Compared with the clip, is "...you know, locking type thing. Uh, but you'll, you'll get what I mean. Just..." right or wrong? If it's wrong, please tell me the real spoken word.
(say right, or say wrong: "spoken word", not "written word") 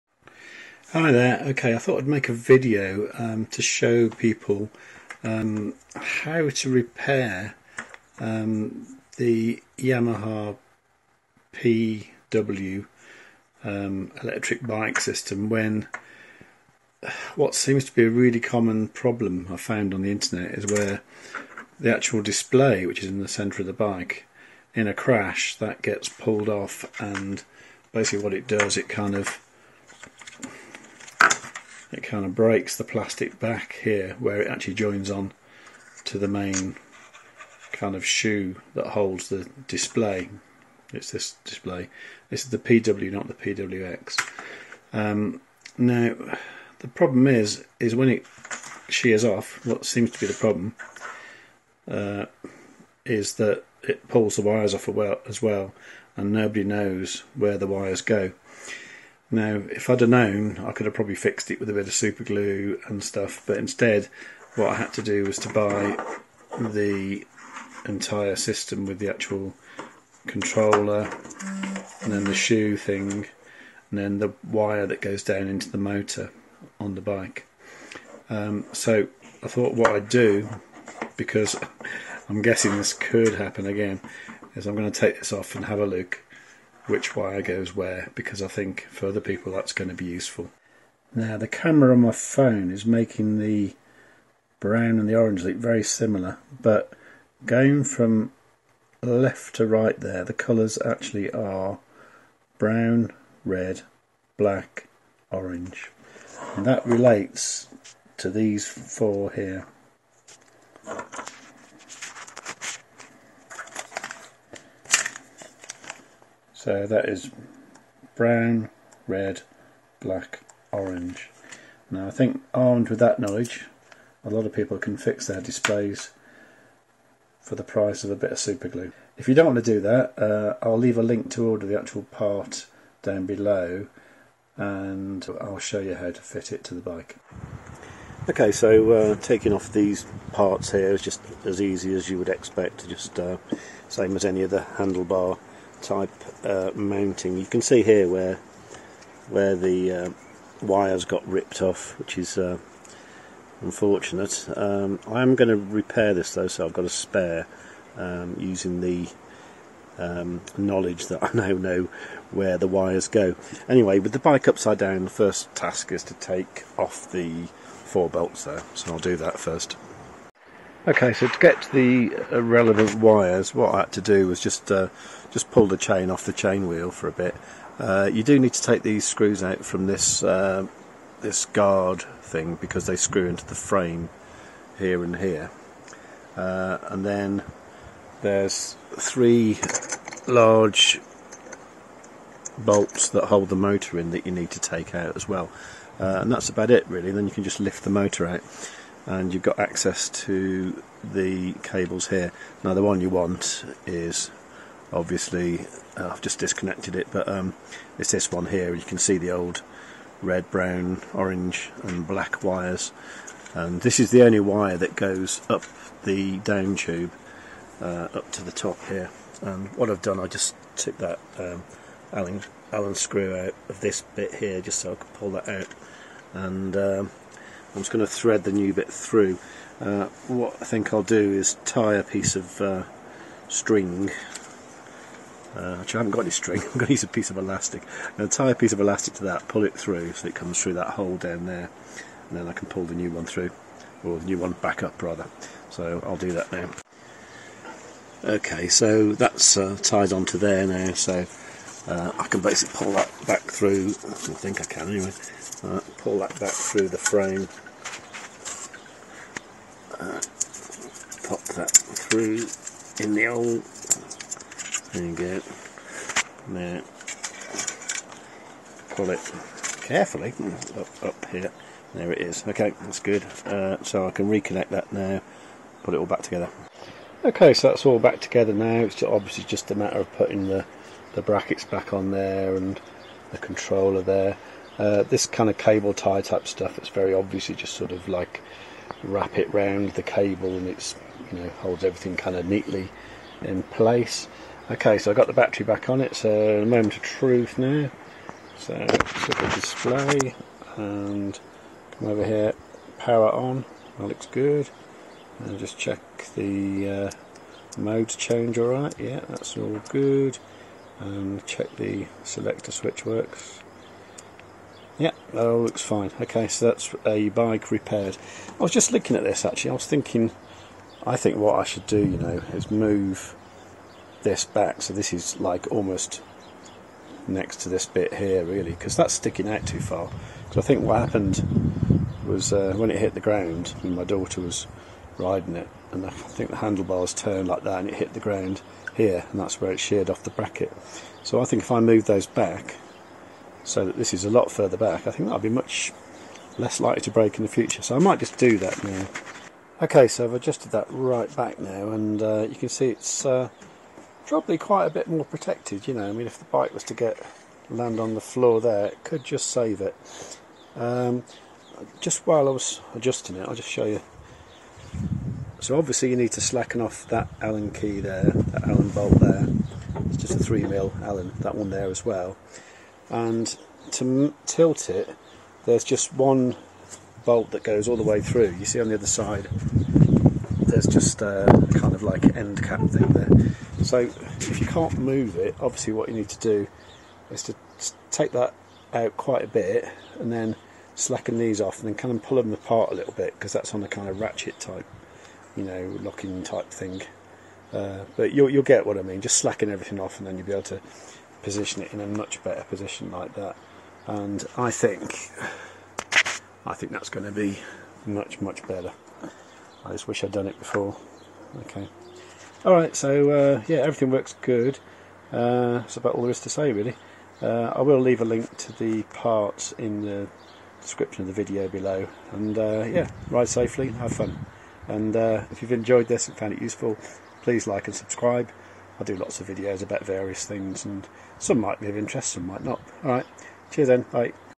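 right.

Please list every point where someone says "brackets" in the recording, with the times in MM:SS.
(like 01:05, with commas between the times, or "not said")
04:41, 05:40.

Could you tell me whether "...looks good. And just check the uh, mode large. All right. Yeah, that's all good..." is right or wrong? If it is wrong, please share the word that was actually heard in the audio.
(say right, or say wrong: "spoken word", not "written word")
wrong: "change", not "large".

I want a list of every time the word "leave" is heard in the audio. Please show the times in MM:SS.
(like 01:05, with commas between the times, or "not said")
02:10, 06:57.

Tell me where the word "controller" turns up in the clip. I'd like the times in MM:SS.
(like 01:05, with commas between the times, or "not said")
01:10, 04:43.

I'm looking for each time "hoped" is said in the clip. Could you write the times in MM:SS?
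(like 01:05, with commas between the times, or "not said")
not said.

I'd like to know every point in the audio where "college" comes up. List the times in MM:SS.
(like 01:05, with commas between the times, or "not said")
not said.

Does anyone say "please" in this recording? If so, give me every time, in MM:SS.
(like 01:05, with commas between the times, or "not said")
07:07.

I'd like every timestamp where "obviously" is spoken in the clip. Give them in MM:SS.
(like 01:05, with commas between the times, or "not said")
03:24, 04:39, 04:47, 06:05, 06:25.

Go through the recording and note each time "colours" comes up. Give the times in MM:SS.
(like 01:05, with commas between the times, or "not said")
01:40.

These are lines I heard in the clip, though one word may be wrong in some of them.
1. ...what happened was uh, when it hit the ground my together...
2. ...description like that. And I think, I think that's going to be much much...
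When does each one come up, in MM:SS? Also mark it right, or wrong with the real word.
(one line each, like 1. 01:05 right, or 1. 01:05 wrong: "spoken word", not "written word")
1. 05:30 wrong: "daughter", not "together"
2. 06:42 wrong: "position", not "description".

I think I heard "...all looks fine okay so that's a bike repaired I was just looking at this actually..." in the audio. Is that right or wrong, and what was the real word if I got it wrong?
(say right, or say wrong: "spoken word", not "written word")
right.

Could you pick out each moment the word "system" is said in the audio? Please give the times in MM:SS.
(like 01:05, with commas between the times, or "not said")
00:14, 01:08.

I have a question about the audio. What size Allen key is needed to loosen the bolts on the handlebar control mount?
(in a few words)
3 mm.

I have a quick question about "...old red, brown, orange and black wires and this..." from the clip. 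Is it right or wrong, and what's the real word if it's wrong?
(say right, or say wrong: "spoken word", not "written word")
right.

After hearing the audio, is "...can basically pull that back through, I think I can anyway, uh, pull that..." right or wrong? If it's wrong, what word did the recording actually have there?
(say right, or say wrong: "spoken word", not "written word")
right.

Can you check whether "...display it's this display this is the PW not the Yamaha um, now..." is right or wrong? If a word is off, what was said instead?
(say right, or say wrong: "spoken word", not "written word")
wrong: "PWX", not "Yamaha".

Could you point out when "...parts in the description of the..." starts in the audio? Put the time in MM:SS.
06:59.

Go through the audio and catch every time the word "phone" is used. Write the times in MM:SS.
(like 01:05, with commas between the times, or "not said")
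01:32.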